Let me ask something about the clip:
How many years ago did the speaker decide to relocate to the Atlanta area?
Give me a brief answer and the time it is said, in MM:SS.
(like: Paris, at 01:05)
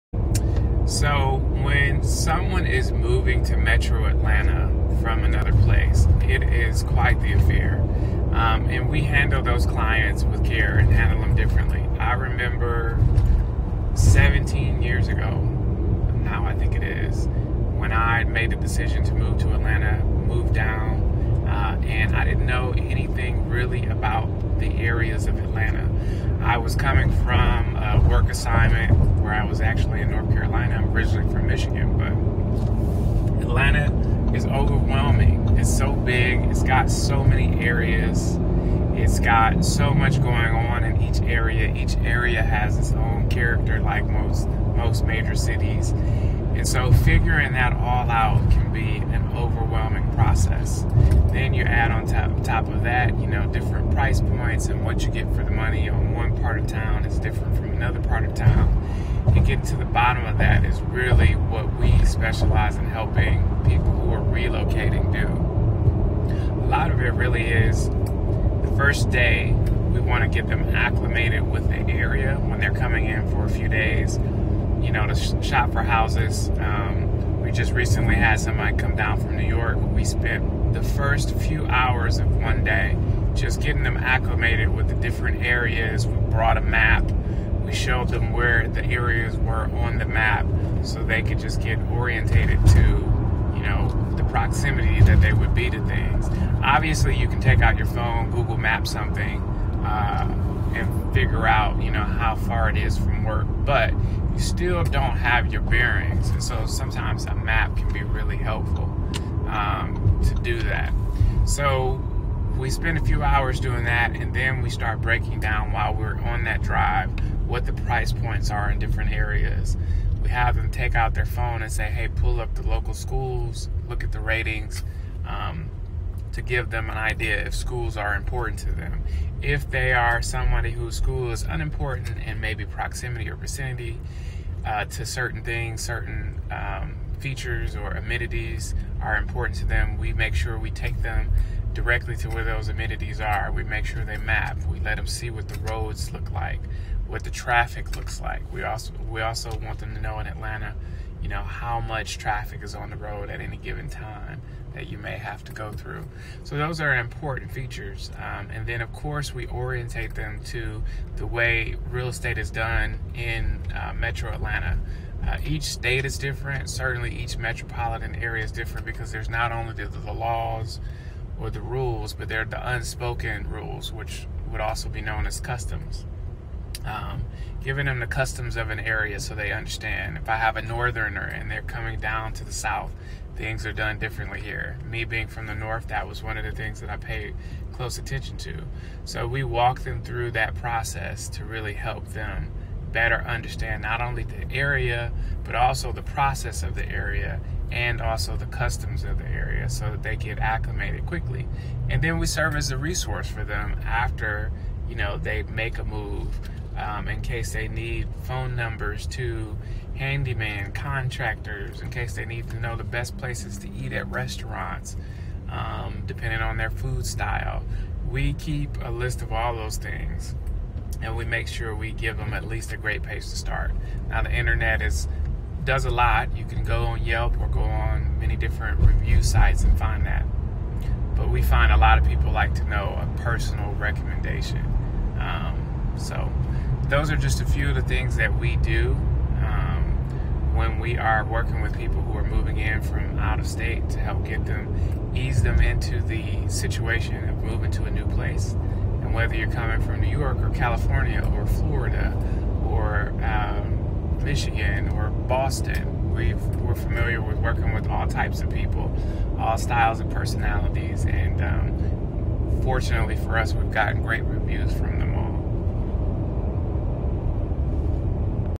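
17, at 00:13.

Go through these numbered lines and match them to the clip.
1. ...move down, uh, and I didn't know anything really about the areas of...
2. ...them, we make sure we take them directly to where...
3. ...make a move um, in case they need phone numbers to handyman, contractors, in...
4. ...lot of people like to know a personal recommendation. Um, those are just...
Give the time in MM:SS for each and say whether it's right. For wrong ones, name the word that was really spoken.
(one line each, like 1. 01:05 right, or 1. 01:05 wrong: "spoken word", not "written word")
1. 00:20 right
2. 02:19 right
3. 03:25 right
4. 03:51 right.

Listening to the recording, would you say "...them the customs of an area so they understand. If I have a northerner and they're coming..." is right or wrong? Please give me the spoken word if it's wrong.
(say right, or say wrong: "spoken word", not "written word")
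right.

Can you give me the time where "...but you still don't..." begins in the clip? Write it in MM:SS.
01:43.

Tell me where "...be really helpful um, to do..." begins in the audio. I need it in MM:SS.
01:47.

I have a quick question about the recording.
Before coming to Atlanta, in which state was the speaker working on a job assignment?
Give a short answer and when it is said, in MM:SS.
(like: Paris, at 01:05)
North Carolina, at 00:30.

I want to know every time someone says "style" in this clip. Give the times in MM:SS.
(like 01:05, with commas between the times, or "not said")
03:37, 04:19.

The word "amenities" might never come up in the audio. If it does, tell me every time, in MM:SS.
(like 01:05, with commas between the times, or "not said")
02:17, 02:22.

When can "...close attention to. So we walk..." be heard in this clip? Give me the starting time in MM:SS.
03:07.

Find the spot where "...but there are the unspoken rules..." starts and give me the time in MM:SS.
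02:52.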